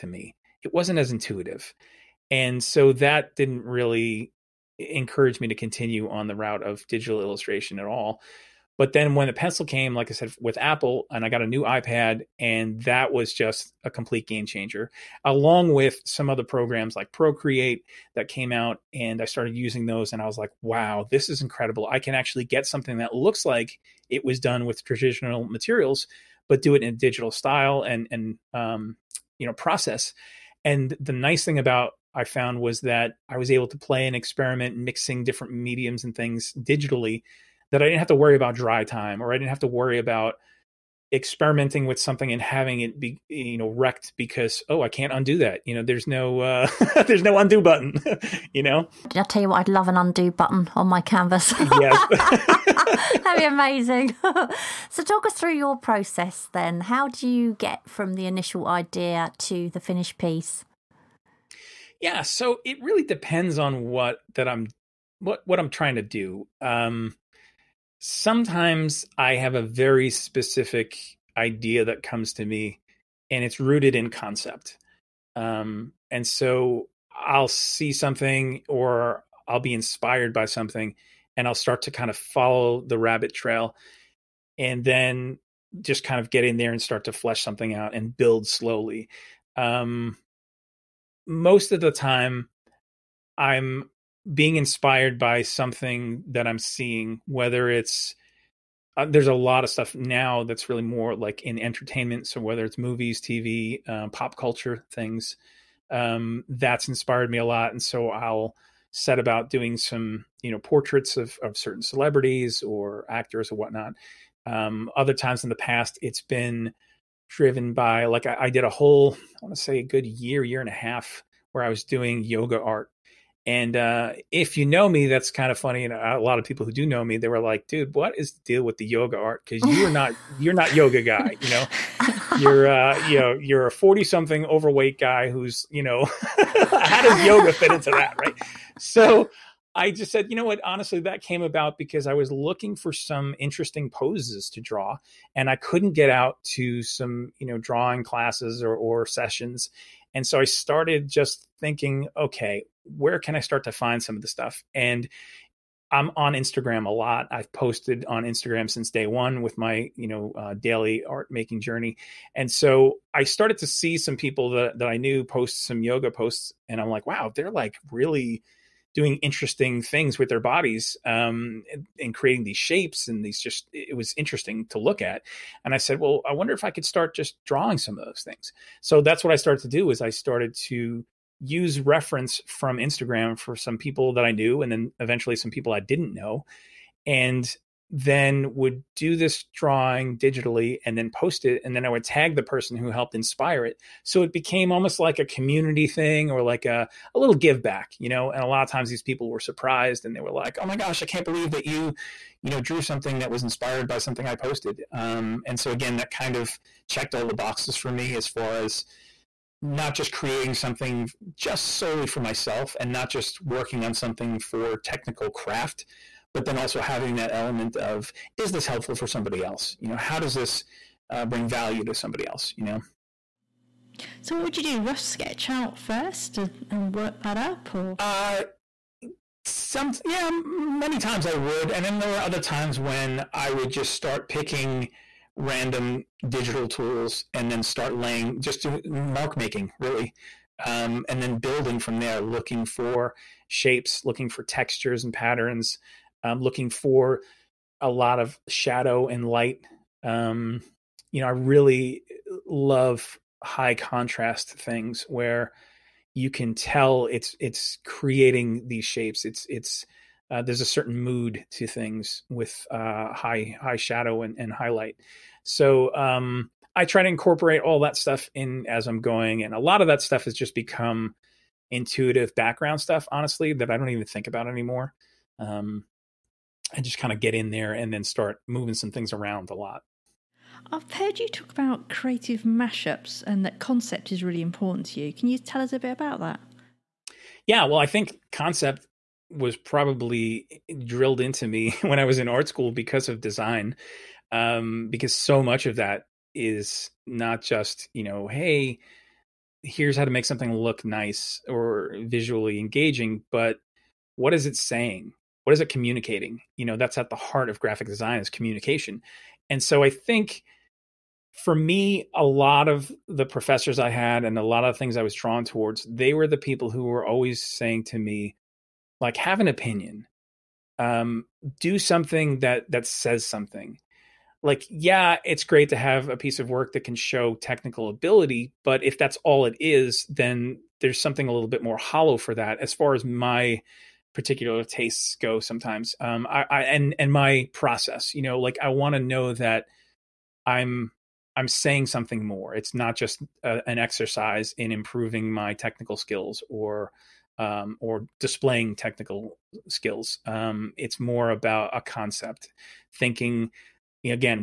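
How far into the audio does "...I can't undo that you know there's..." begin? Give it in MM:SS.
00:44.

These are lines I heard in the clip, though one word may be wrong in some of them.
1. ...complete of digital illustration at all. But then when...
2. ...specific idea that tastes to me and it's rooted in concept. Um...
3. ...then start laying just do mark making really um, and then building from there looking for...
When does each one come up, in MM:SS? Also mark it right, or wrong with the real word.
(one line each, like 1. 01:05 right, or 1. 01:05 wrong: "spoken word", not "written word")
1. 00:06 wrong: "route", not "complete"
2. 01:10 wrong: "comes", not "tastes"
3. 03:57 right.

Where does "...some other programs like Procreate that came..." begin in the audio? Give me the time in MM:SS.
00:16.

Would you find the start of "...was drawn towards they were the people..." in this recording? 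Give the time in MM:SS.
05:15.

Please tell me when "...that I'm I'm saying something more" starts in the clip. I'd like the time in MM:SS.
05:39.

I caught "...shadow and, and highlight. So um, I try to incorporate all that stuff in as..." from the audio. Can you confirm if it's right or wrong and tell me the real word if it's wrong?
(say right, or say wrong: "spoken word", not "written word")
right.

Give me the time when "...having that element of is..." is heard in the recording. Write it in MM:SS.
03:36.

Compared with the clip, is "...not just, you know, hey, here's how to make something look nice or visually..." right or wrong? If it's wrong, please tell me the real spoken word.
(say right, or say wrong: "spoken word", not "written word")
right.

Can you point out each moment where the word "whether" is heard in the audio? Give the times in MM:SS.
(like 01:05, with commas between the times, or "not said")
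01:37, 01:42.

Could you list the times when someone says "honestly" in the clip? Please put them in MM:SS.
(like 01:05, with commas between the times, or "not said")
02:20, 04:33.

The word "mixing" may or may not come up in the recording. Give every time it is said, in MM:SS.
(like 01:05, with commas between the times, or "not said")
00:34.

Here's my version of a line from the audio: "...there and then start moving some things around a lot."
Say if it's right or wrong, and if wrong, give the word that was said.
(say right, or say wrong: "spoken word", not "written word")
right.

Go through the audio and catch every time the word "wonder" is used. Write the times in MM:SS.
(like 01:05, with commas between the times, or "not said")
02:56.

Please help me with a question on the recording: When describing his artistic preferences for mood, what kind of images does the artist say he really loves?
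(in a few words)
high contrast.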